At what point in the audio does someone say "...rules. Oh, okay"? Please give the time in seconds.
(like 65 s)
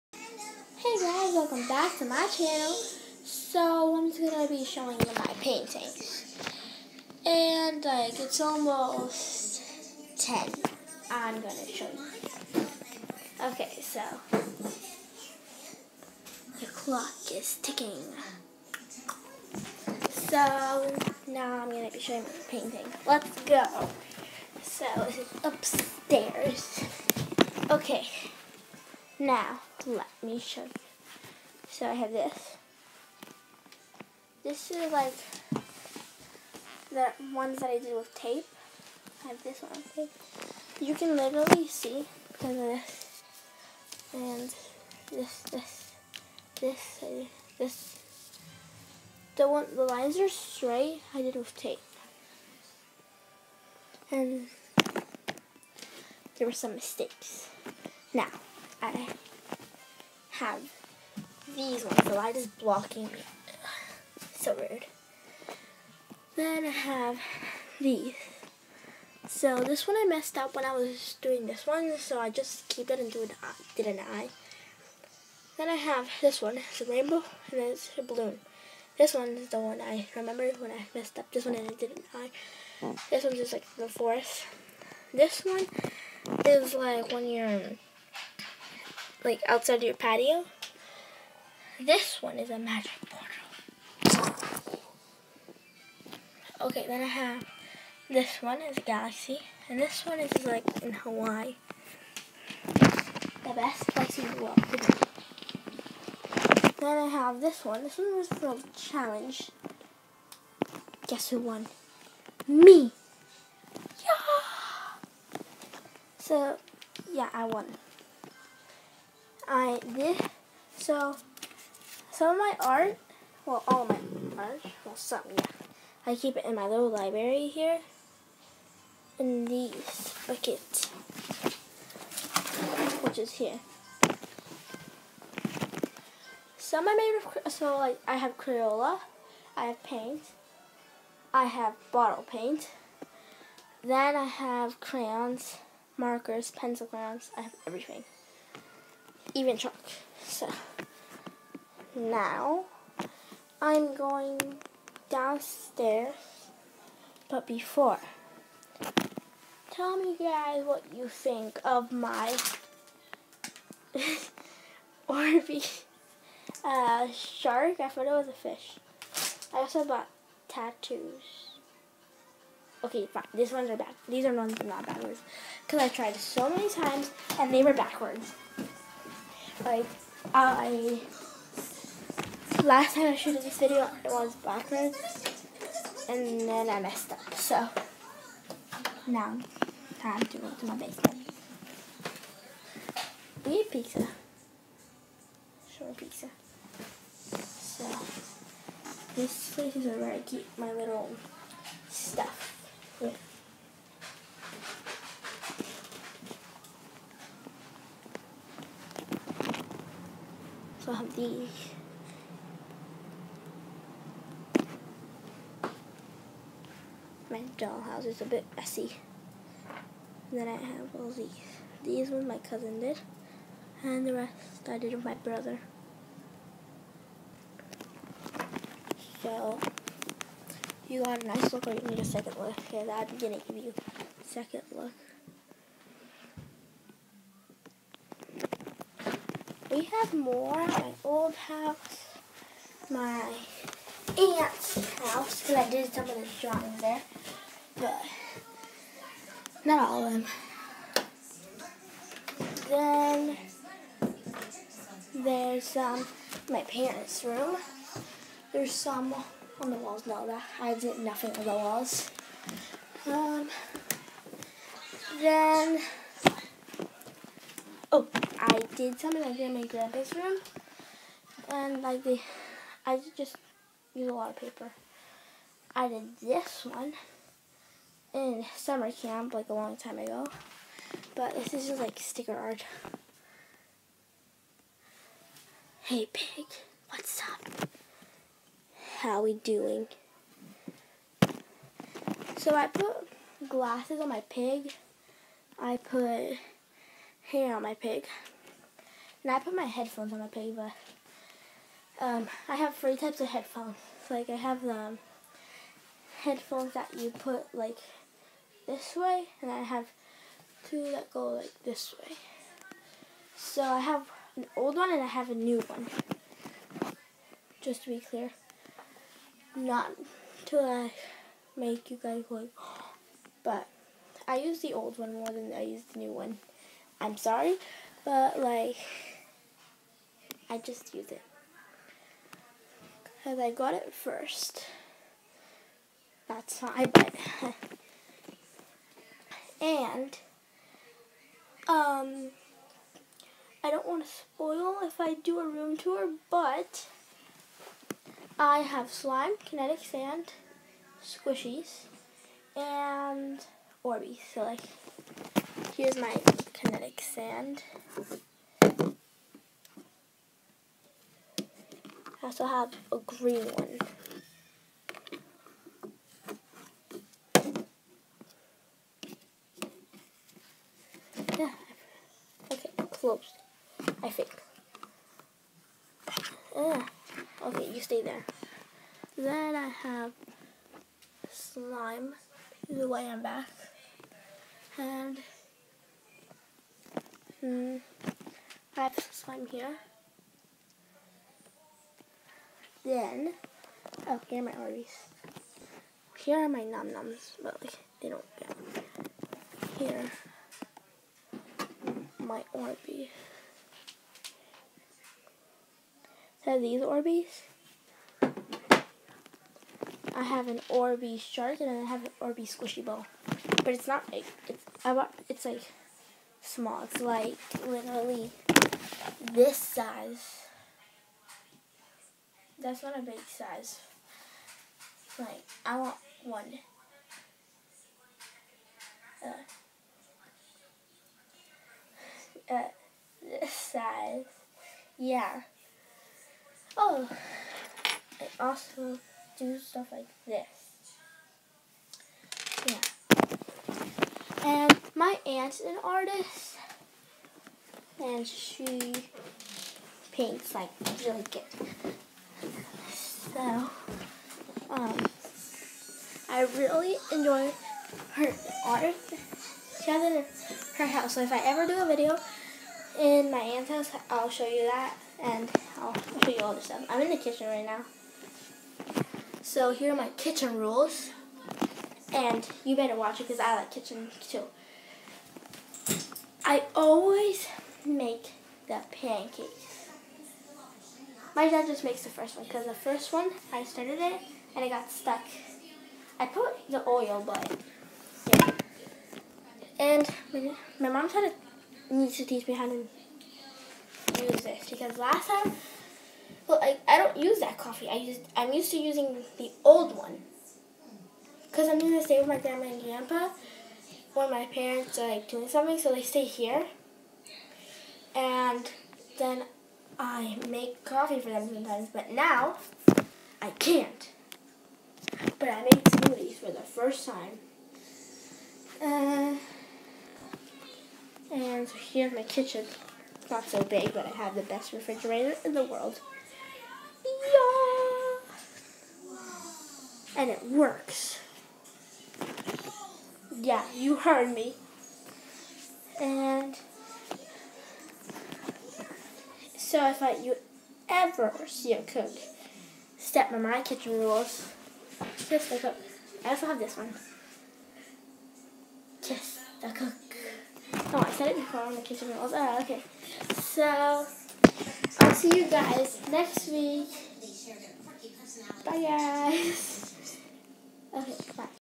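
552 s.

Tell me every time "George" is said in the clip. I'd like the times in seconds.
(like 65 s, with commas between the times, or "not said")
not said.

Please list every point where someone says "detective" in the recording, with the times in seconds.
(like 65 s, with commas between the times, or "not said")
not said.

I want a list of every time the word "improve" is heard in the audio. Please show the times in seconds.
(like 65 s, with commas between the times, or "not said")
not said.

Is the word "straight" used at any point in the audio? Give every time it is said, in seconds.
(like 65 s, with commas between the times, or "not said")
50 s.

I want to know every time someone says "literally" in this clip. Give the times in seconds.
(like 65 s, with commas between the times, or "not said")
41 s, 417 s.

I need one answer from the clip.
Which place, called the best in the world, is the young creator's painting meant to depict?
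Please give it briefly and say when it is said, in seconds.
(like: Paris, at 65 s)
Hawaii, at 100 s.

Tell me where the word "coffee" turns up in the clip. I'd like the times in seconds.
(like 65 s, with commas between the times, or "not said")
497 s, 510 s.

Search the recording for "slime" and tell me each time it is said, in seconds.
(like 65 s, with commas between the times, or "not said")
348 s, 381 s, 389 s.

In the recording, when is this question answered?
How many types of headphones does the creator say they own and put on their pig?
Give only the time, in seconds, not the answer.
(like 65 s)
302 s.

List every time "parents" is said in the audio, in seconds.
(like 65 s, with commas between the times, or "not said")
256 s, 504 s.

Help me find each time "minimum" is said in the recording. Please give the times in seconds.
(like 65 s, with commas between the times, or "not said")
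not said.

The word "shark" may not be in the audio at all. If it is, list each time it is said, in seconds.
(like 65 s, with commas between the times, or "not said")
167 s, 411 s.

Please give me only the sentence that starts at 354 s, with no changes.
So, like, Here's my kinetic sand.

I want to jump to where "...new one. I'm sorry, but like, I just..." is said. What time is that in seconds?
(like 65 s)
325 s.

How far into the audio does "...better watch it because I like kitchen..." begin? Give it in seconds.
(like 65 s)
472 s.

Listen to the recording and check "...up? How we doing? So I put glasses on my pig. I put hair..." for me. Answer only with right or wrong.
right.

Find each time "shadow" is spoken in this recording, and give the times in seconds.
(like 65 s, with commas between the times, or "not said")
not said.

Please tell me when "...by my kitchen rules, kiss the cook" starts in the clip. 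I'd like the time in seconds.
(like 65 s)
543 s.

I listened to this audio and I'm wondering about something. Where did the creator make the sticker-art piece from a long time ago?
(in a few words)
summer camp.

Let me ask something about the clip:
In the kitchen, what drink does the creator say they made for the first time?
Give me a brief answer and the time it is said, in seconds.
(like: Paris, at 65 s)
smoothies, at 515 s.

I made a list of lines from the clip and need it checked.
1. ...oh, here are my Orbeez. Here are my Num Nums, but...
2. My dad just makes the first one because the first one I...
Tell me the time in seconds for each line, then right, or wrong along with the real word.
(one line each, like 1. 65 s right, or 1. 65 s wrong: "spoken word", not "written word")
1. 394 s right
2. 481 s right.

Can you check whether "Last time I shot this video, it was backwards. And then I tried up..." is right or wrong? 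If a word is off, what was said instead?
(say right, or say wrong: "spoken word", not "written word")
wrong: "messed", not "tried".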